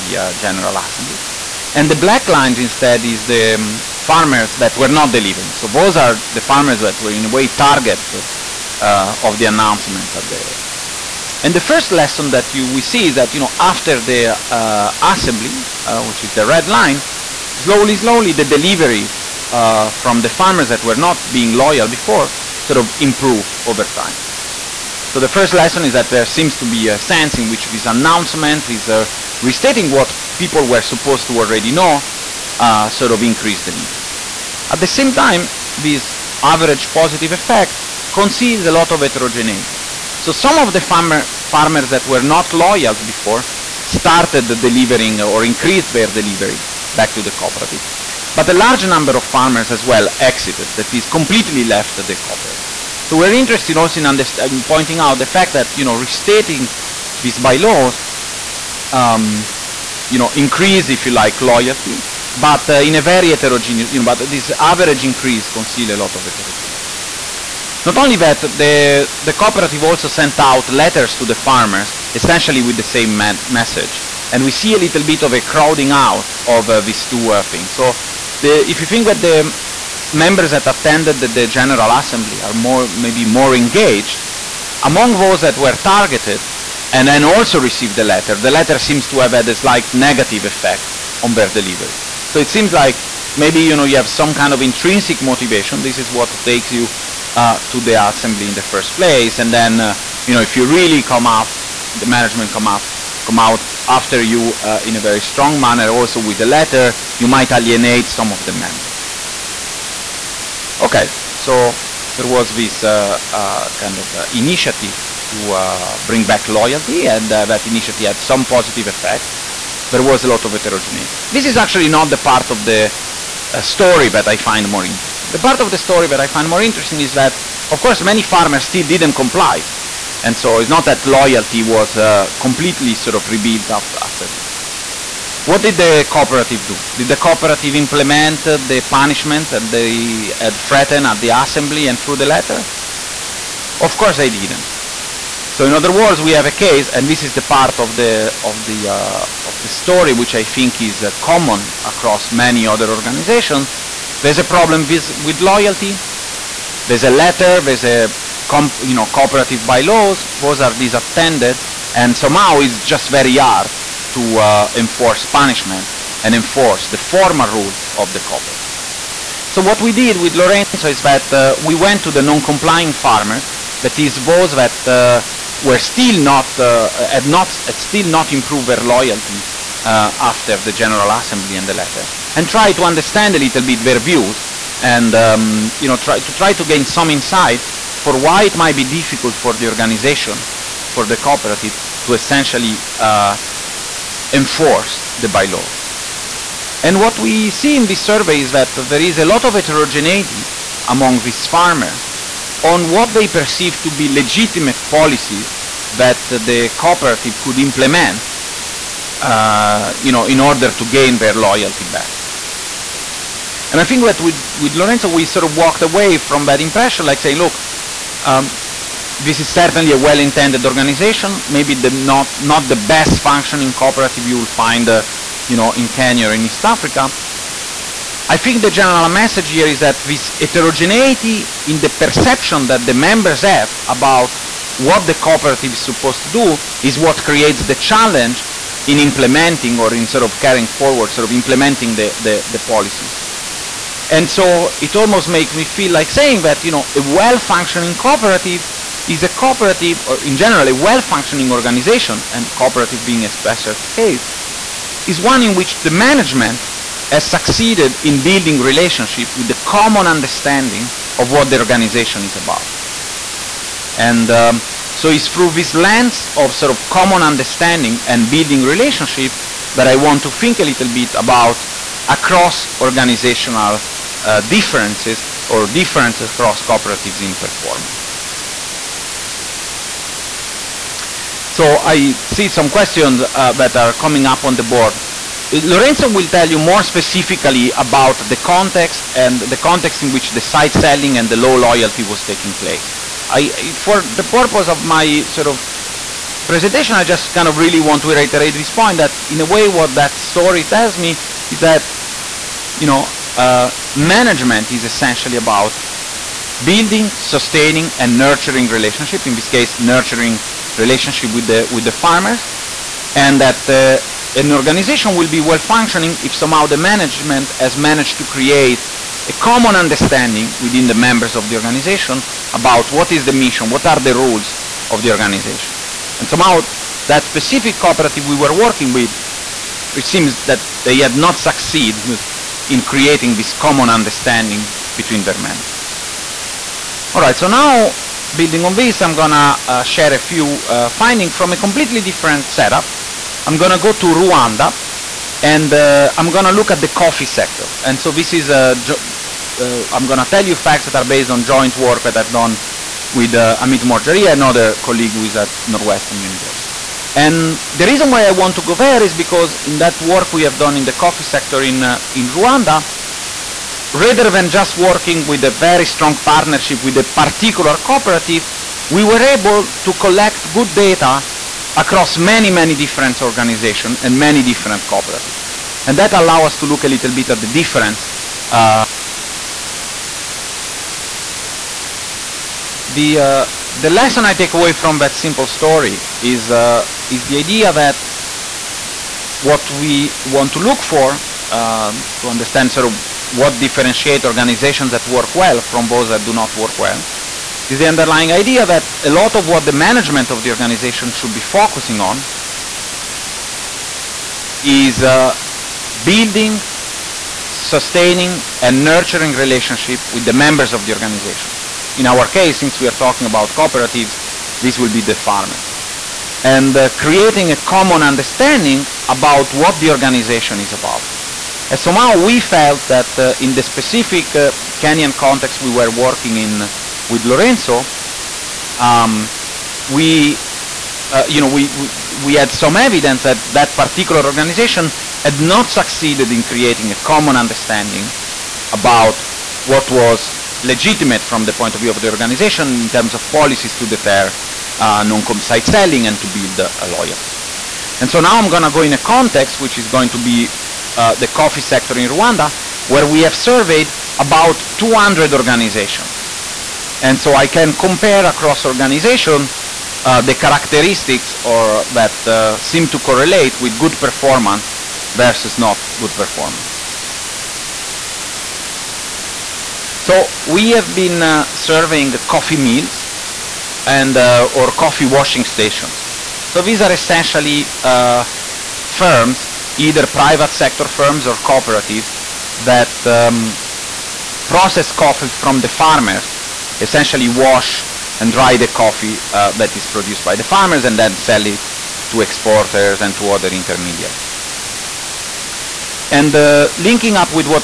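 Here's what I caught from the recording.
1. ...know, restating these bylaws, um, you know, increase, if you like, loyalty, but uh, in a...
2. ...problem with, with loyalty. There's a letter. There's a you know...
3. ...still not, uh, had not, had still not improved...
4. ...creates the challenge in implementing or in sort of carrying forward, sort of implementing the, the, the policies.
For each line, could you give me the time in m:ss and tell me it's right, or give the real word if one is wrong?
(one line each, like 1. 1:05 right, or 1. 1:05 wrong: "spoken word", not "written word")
1. 0:55 right
2. 2:34 right
3. 2:55 right
4. 3:57 right.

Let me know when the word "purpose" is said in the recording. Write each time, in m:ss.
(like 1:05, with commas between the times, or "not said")
4:54.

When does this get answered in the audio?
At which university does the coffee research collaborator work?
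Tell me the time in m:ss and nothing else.
5:55.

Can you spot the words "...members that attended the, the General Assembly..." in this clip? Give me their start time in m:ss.
1:20.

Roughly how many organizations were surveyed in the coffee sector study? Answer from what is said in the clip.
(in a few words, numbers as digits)
200.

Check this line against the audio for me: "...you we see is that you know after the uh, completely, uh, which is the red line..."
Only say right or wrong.
wrong.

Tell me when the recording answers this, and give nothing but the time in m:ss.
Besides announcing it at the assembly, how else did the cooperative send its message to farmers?
1:10.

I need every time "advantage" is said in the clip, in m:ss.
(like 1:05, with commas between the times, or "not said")
not said.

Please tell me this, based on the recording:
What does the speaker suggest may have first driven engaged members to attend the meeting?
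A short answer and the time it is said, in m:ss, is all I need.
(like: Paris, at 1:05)
Intrinsic motivation, at 1:34.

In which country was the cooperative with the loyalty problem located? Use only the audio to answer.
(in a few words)
Kenya.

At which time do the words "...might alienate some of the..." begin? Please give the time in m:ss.
1:47.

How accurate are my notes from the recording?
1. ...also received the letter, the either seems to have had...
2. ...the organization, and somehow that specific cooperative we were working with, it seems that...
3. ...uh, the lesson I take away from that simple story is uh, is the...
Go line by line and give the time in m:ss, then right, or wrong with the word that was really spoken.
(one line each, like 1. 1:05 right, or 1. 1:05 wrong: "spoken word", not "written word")
1. 1:27 wrong: "letter", not "either"
2. 5:25 right
3. 6:23 right.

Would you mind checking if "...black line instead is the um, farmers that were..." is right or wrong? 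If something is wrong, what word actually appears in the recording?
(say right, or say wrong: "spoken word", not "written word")
right.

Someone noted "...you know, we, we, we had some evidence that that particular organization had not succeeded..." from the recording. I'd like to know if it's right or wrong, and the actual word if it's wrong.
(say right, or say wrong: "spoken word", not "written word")
right.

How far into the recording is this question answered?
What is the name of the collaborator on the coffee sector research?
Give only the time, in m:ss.
5:53.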